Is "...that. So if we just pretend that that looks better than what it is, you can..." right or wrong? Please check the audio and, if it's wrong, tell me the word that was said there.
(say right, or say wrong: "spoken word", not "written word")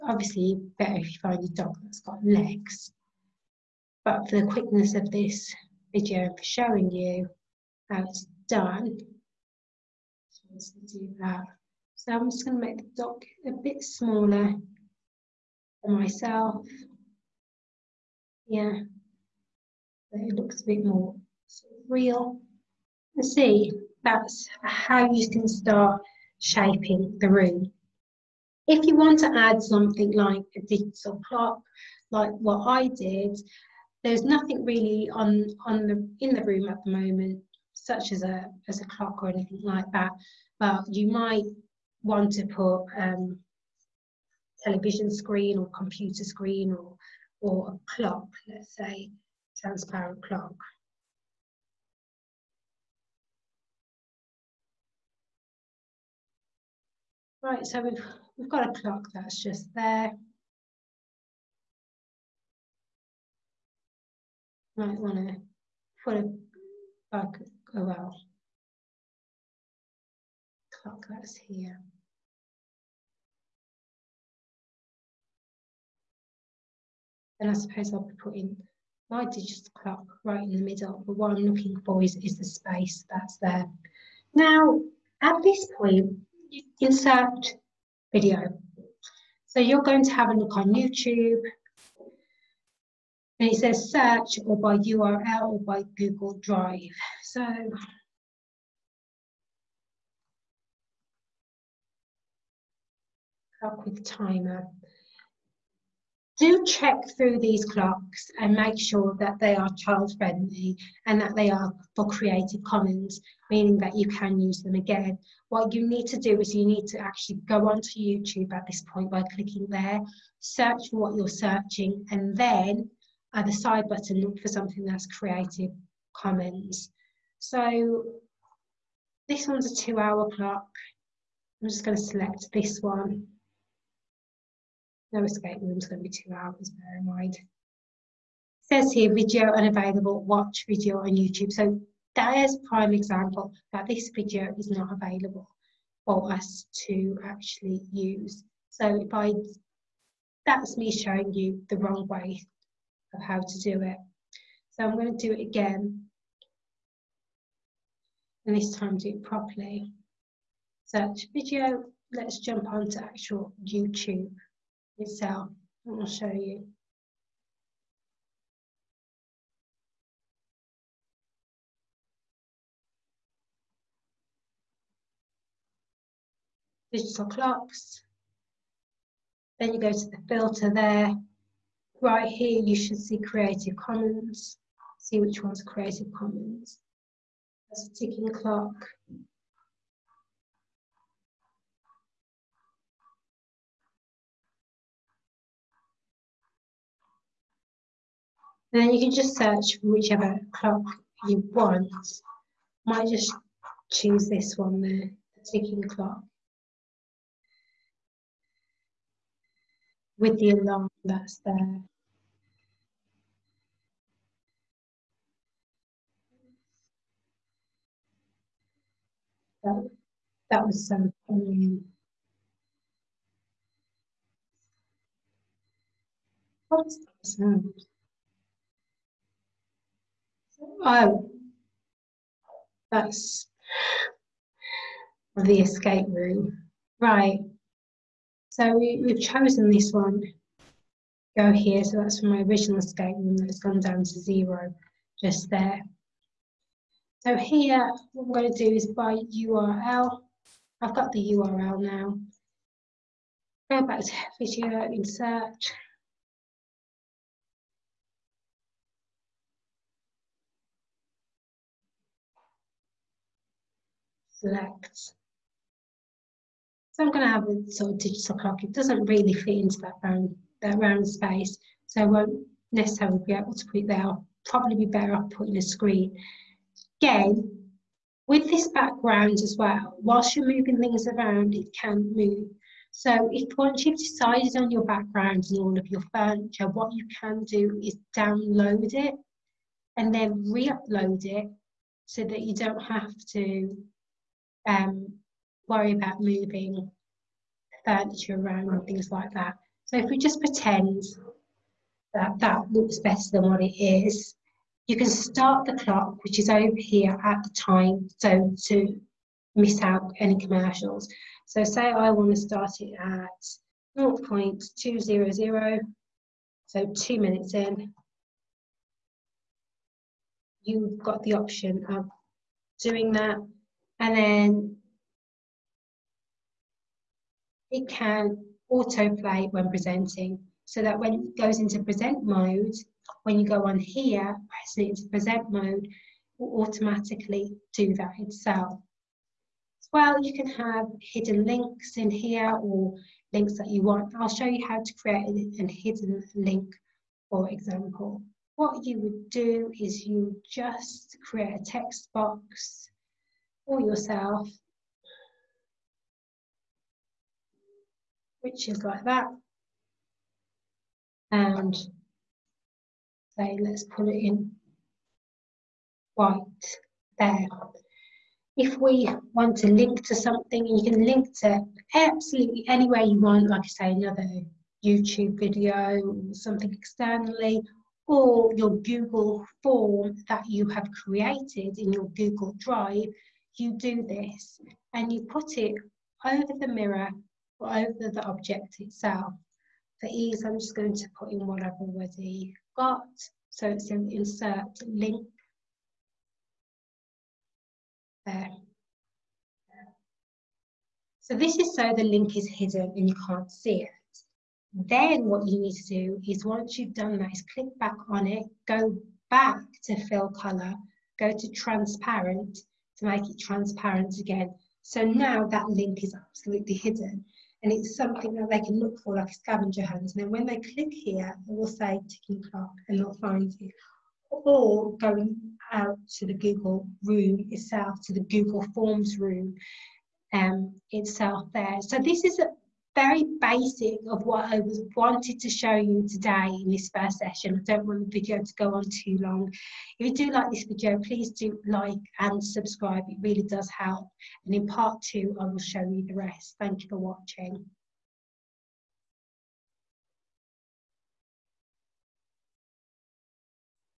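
right.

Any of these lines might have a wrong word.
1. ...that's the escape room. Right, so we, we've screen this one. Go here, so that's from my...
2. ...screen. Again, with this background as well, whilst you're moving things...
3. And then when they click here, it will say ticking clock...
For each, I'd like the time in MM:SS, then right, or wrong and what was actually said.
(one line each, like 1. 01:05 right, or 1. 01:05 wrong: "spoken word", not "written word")
1. 03:52 wrong: "chosen", not "screen"
2. 04:35 right
3. 07:00 right.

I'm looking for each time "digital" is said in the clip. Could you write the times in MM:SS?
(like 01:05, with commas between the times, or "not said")
00:30, 01:19, 02:56, 04:27.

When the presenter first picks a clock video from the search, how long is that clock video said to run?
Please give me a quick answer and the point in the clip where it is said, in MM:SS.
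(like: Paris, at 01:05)
2 hours, at 02:09.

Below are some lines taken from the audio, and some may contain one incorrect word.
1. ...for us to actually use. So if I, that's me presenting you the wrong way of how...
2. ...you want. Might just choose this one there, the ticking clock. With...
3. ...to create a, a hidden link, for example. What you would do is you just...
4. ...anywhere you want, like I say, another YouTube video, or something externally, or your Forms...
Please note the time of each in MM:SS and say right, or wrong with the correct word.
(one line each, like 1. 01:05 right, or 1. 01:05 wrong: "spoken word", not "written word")
1. 02:26 wrong: "showing", not "presenting"
2. 03:21 right
3. 05:44 right
4. 06:12 wrong: "Google", not "Forms".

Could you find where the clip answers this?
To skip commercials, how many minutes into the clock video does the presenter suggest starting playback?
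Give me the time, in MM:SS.
05:16.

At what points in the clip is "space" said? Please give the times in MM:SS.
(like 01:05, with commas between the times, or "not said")
01:22, 04:31.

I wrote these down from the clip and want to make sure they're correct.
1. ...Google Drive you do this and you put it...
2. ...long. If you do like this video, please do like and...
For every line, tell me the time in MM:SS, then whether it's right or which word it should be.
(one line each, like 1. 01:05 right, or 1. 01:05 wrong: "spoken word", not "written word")
1. 06:22 right
2. 07:19 right.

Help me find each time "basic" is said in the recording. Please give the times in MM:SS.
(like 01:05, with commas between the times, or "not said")
07:13.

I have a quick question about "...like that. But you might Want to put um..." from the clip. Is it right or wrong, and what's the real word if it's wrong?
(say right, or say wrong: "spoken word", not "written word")
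right.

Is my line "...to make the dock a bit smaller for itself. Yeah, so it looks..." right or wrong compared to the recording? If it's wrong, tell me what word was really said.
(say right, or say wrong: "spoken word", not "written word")
wrong: "myself", not "itself".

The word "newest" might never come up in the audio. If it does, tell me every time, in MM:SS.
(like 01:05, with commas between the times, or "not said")
not said.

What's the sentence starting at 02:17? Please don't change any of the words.
It says here, video unavailable, watch video on YouTube.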